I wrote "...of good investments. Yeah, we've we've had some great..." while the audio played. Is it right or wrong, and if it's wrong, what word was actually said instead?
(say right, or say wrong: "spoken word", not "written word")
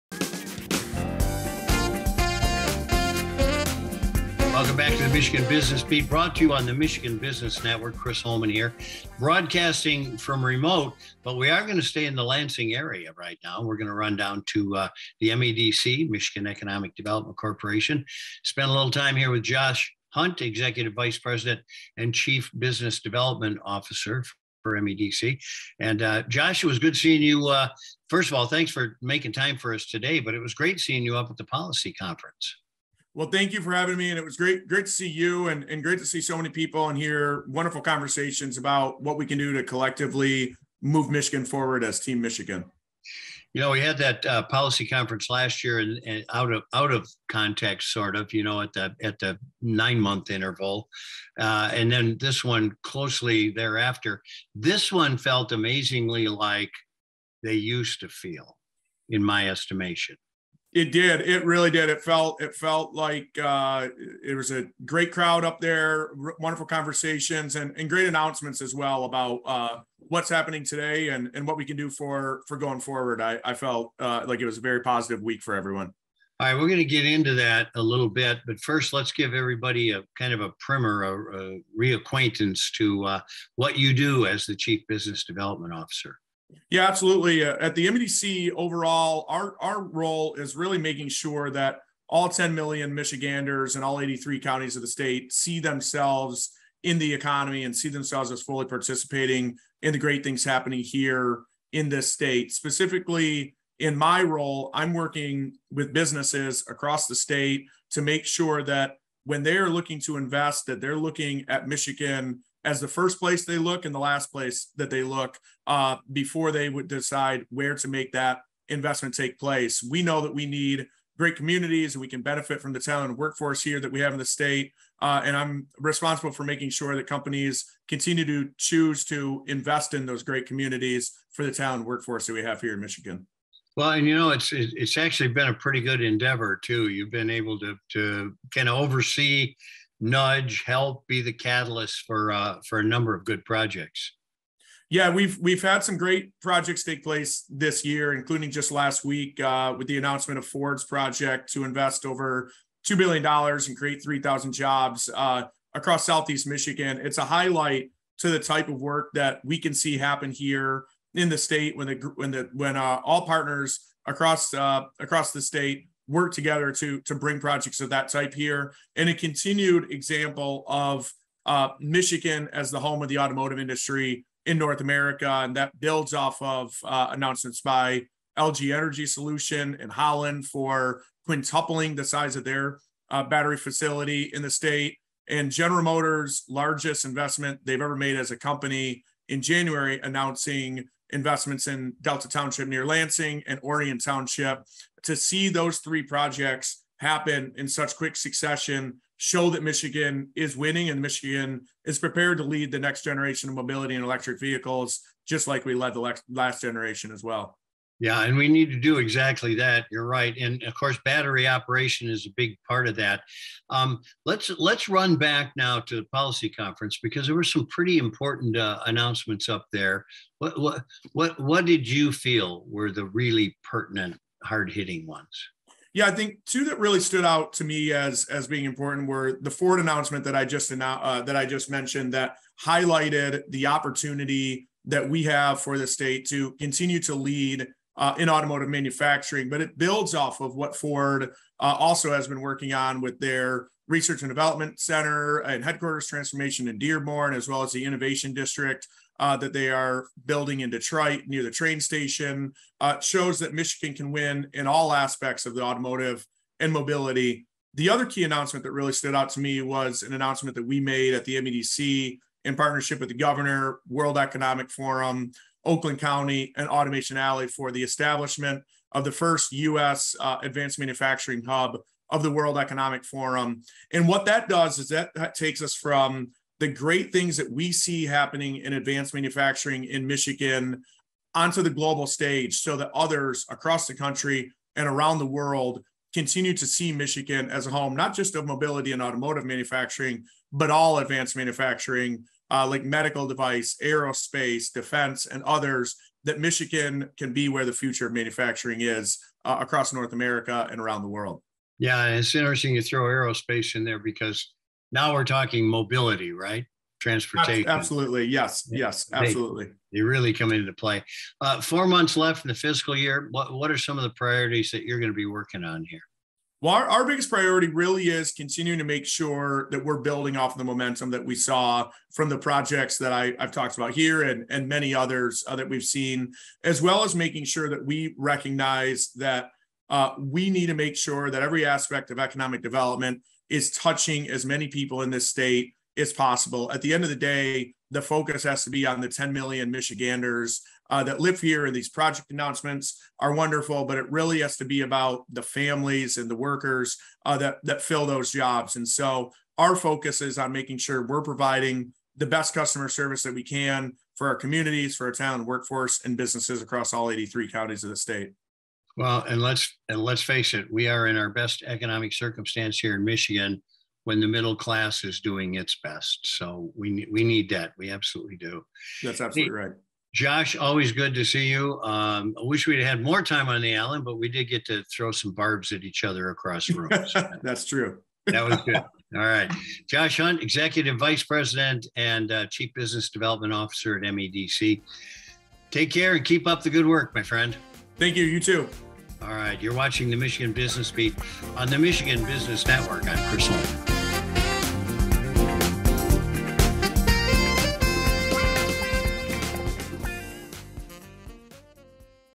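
wrong: "projects", not "investments".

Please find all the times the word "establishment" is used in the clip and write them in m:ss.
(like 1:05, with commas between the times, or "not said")
4:27.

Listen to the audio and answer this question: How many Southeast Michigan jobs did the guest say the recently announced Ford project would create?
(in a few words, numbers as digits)
3,000.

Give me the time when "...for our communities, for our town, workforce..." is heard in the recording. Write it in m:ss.
5:54.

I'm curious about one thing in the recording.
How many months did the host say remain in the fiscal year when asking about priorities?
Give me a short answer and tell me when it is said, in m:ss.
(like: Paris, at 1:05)
4, at 5:11.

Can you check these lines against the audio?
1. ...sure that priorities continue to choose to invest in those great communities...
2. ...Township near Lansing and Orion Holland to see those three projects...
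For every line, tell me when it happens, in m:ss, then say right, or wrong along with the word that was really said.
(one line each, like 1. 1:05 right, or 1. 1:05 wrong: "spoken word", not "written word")
1. 2:06 wrong: "companies", not "priorities"
2. 3:12 wrong: "Township", not "Holland".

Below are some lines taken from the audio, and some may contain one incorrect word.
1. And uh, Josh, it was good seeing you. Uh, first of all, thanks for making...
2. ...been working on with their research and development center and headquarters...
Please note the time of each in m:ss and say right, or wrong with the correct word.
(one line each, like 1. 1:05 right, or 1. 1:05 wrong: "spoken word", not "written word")
1. 0:25 right
2. 4:02 right.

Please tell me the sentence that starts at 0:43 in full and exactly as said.
You know, we had that uh, policy conference last year, and, and, out of out of context, sort of.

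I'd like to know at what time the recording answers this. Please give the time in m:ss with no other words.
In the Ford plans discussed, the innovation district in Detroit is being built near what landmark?
4:11.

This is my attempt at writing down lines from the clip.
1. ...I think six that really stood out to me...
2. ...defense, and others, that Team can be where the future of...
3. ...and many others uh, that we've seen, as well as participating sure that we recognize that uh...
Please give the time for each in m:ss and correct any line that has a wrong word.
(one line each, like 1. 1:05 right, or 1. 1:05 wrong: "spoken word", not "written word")
1. 3:46 wrong: "two", not "six"
2. 4:54 wrong: "Michigan", not "Team"
3. 5:24 wrong: "making", not "participating".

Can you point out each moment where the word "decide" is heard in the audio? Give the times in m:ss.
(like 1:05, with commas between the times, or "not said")
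1:56.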